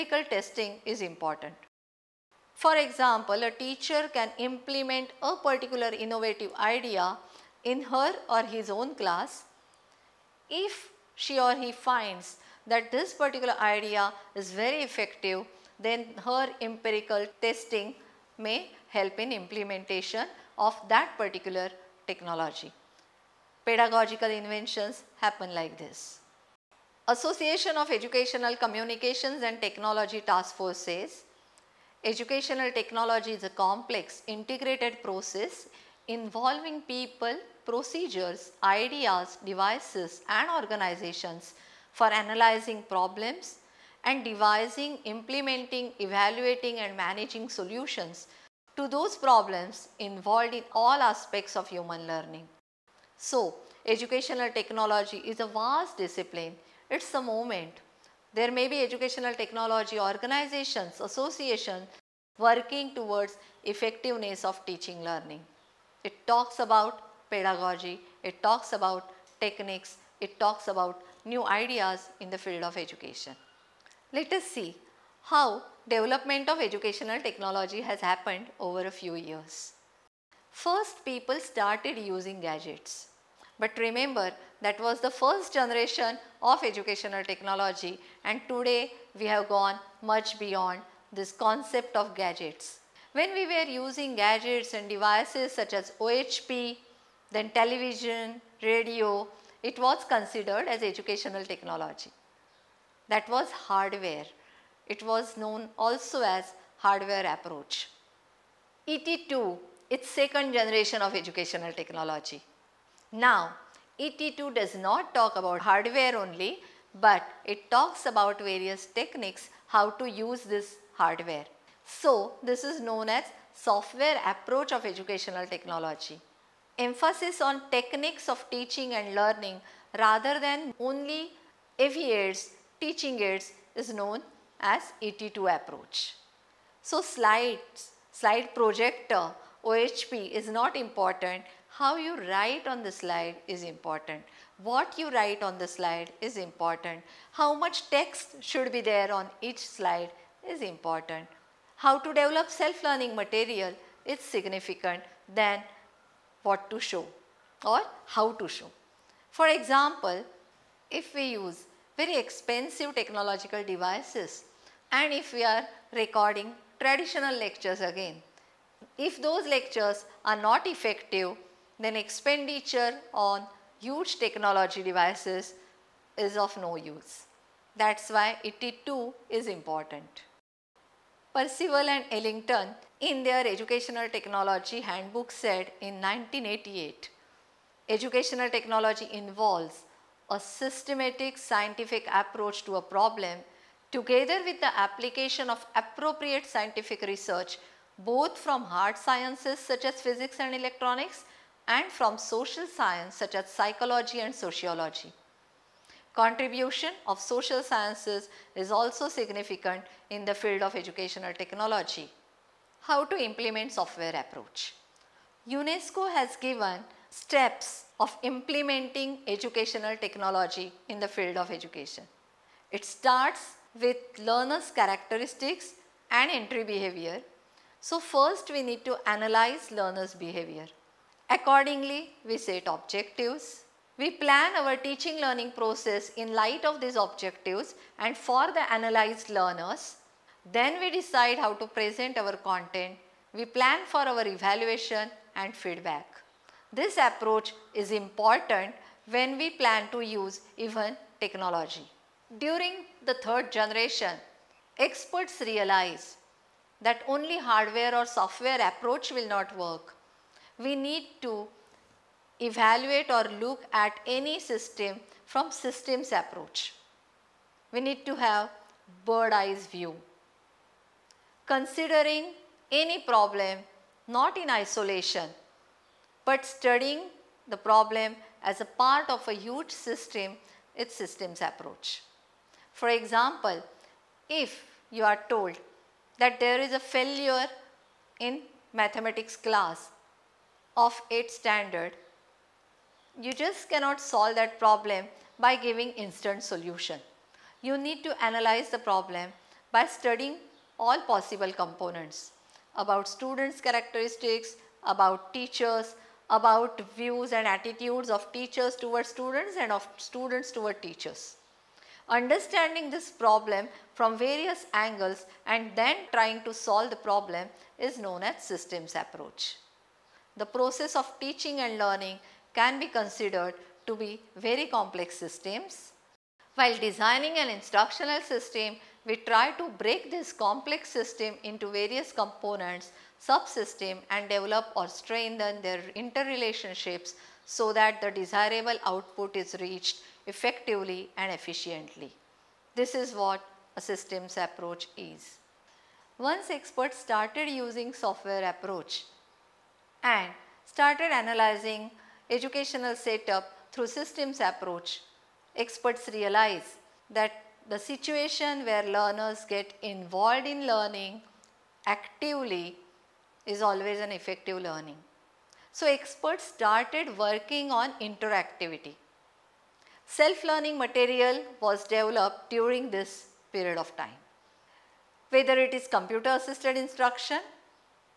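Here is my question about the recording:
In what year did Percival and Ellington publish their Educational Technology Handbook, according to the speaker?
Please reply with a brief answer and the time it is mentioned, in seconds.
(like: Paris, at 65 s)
1988, at 185 s.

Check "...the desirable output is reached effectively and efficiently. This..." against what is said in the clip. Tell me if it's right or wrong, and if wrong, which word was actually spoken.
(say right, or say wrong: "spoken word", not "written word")
right.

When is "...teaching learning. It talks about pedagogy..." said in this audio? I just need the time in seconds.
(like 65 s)
64 s.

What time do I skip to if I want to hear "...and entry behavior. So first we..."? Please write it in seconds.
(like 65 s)
226 s.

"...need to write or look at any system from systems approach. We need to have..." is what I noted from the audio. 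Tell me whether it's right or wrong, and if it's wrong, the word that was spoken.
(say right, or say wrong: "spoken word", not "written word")
wrong: "evaluate", not "write".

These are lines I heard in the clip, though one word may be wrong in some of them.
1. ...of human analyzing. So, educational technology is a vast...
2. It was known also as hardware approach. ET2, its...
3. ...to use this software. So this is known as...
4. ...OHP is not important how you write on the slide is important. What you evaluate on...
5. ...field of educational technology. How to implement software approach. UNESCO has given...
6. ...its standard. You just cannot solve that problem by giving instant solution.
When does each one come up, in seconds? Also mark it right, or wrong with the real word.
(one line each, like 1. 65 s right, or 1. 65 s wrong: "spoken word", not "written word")
1. 51 s wrong: "learning", not "analyzing"
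2. 104 s right
3. 119 s wrong: "hardware", not "software"
4. 139 s wrong: "write", not "evaluate"
5. 210 s right
6. 291 s right.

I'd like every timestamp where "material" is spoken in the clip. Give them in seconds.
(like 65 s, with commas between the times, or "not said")
153 s, 370 s.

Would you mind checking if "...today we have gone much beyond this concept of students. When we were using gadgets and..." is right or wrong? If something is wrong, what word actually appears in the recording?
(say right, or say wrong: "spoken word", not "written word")
wrong: "gadgets", not "students".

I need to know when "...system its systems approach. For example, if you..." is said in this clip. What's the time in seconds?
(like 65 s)
279 s.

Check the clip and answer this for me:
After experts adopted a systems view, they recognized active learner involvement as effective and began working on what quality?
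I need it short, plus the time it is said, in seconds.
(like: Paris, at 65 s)
interactivity, at 368 s.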